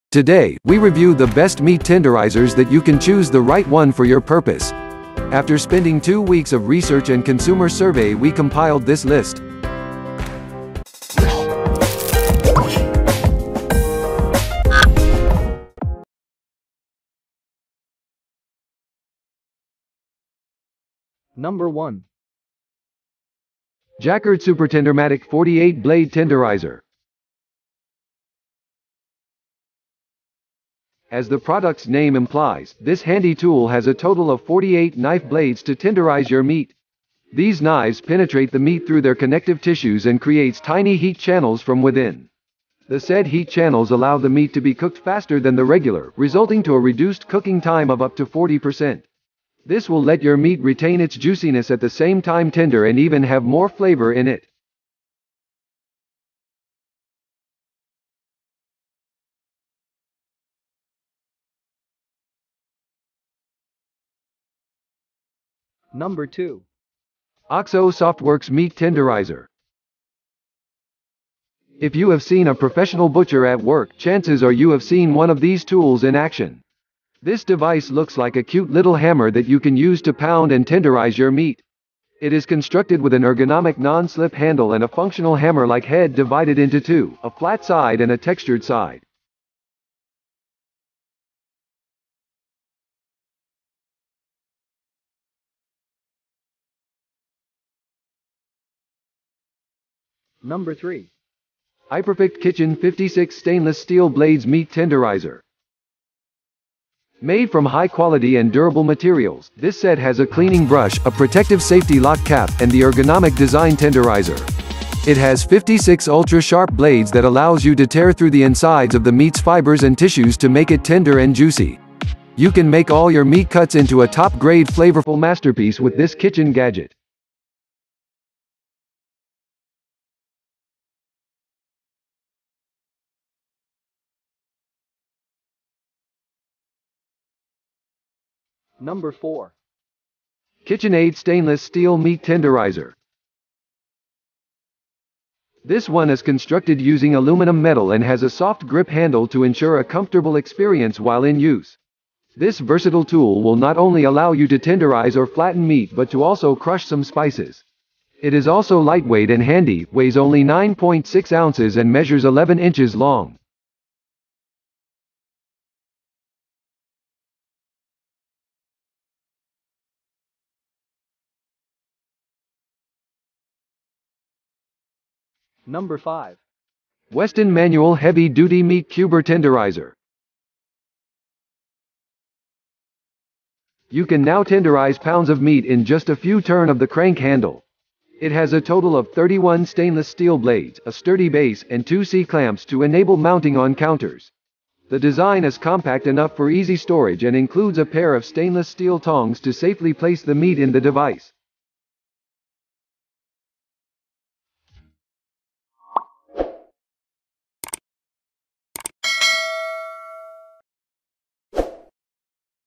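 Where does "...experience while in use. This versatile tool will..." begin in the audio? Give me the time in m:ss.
2:30.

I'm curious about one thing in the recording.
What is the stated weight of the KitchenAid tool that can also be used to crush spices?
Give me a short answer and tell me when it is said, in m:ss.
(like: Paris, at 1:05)
9.6 ounces, at 2:40.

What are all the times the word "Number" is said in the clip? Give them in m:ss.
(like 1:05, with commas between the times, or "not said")
0:21, 1:05, 1:40, 2:18, 2:55.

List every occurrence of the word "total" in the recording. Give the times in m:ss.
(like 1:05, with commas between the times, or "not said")
0:33, 3:08.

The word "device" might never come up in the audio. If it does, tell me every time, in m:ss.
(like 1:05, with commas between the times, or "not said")
1:17, 3:20.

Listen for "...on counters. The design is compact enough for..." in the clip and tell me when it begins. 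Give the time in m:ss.
3:13.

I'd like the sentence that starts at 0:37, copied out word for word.
These knives penetrate the meat through their connective tissues and creates tiny heat channels from within.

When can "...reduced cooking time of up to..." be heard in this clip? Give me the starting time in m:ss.
0:46.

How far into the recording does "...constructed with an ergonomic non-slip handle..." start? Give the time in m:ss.
1:22.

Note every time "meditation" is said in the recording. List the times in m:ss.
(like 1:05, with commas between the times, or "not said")
not said.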